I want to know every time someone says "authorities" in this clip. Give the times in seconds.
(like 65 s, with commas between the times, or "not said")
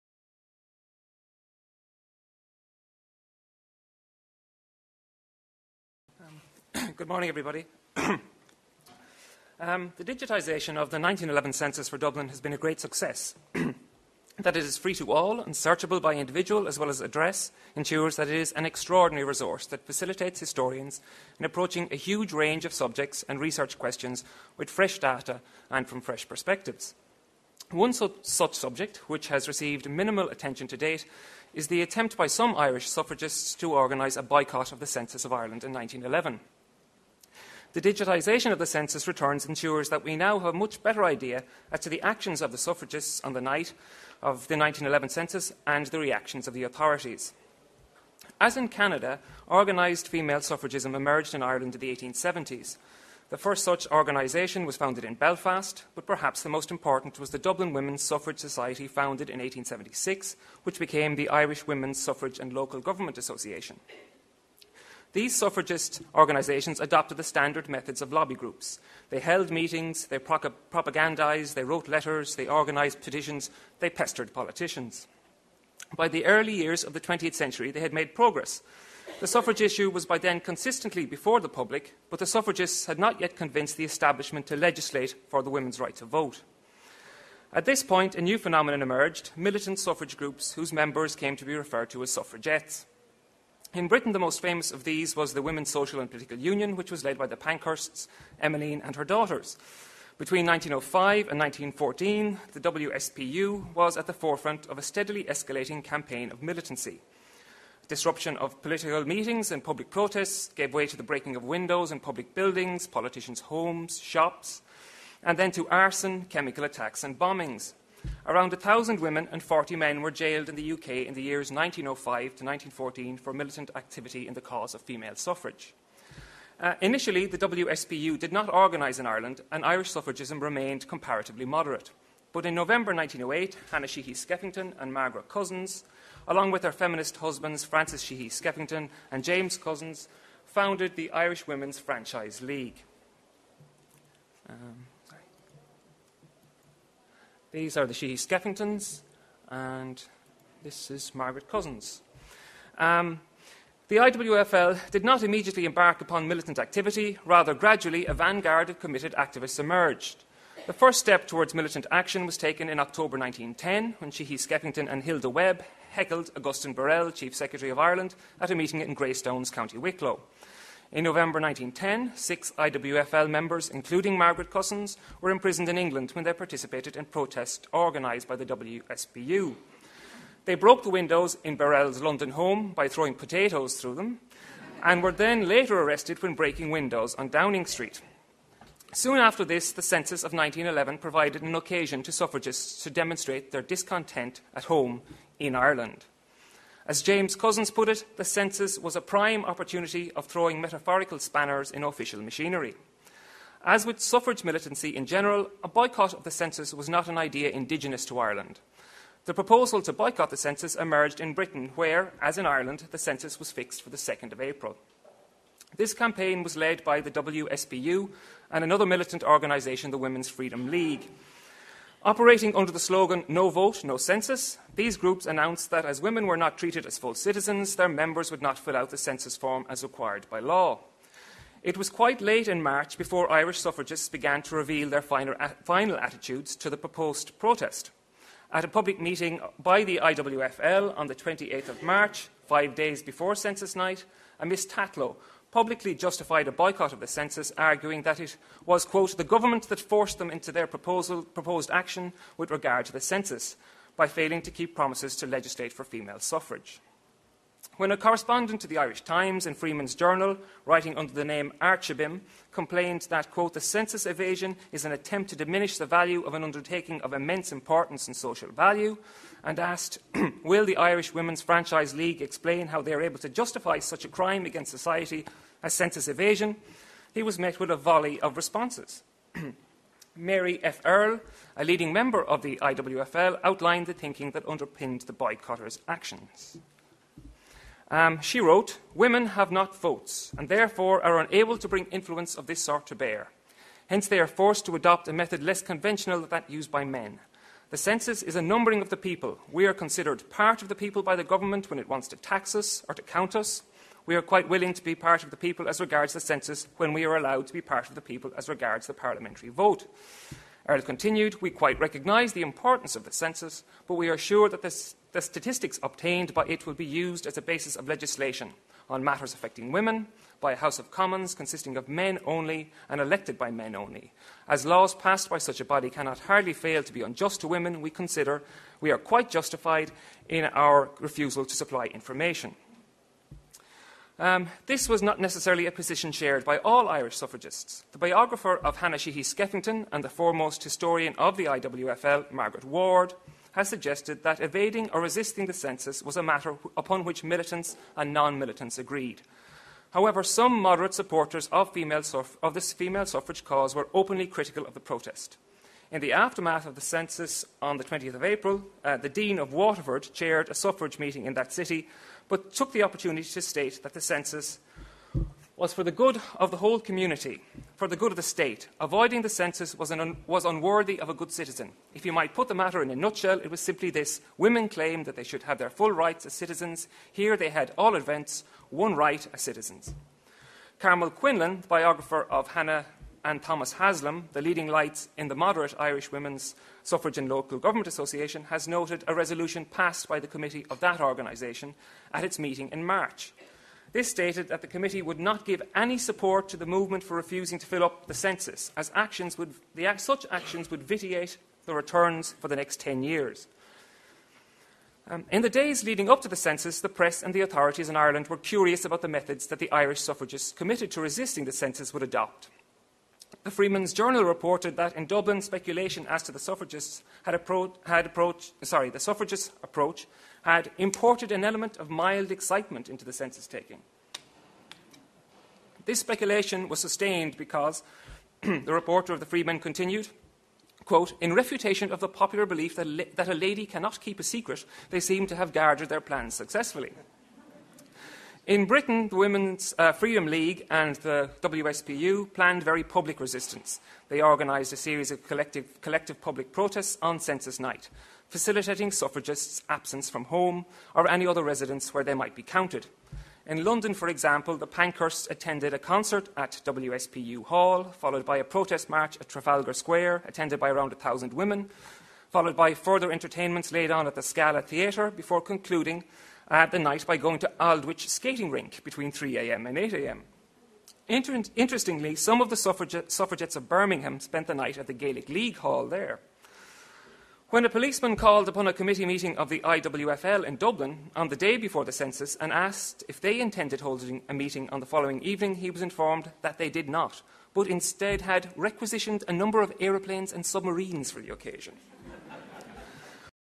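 46 s, 407 s.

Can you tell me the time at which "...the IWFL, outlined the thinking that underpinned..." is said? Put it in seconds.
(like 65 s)
282 s.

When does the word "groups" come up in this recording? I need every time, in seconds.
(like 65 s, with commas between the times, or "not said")
68 s, 90 s, 224 s.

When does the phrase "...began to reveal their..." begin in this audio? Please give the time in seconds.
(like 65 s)
234 s.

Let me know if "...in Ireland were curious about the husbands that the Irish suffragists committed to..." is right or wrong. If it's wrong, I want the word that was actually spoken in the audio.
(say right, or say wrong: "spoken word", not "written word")
wrong: "methods", not "husbands".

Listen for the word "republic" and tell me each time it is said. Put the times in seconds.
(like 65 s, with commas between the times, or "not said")
not said.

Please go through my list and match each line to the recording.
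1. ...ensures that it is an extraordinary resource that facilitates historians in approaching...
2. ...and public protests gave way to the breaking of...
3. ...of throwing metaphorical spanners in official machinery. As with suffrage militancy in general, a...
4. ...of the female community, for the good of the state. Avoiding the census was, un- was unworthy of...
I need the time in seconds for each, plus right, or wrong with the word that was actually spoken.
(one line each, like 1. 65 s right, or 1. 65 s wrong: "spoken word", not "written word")
1. 17 s right
2. 109 s right
3. 200 s right
4. 366 s wrong: "whole", not "female".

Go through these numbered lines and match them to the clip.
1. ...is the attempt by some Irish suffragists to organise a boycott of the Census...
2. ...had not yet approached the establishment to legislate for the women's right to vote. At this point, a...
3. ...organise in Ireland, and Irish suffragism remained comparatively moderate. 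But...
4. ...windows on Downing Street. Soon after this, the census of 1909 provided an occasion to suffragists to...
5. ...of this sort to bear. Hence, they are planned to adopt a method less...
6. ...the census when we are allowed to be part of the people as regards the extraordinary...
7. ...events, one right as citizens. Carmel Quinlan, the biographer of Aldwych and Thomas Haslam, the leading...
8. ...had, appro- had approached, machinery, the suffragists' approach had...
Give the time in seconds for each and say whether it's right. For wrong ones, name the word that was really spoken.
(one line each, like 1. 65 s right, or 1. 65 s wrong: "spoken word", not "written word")
1. 31 s right
2. 82 s wrong: "convinced", not "approached"
3. 128 s right
4. 186 s wrong: "1911", not "1909"
5. 292 s wrong: "forced", not "planned"
6. 306 s wrong: "parliamentary", not "extraordinary"
7. 377 s wrong: "Anna", not "Aldwych"
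8. 417 s wrong: "sorry", not "machinery".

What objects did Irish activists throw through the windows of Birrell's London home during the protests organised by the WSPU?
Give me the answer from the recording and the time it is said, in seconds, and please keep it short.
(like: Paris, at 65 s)
Potatoes, at 183 s.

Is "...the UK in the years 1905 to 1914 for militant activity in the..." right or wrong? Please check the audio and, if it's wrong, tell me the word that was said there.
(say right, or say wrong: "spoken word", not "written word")
right.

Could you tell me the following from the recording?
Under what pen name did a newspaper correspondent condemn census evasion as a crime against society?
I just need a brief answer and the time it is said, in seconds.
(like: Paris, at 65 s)
Archibim, at 261 s.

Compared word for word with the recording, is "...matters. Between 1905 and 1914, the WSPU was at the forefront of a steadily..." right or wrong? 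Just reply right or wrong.
wrong.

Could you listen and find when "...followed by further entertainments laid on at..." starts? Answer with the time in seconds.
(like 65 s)
462 s.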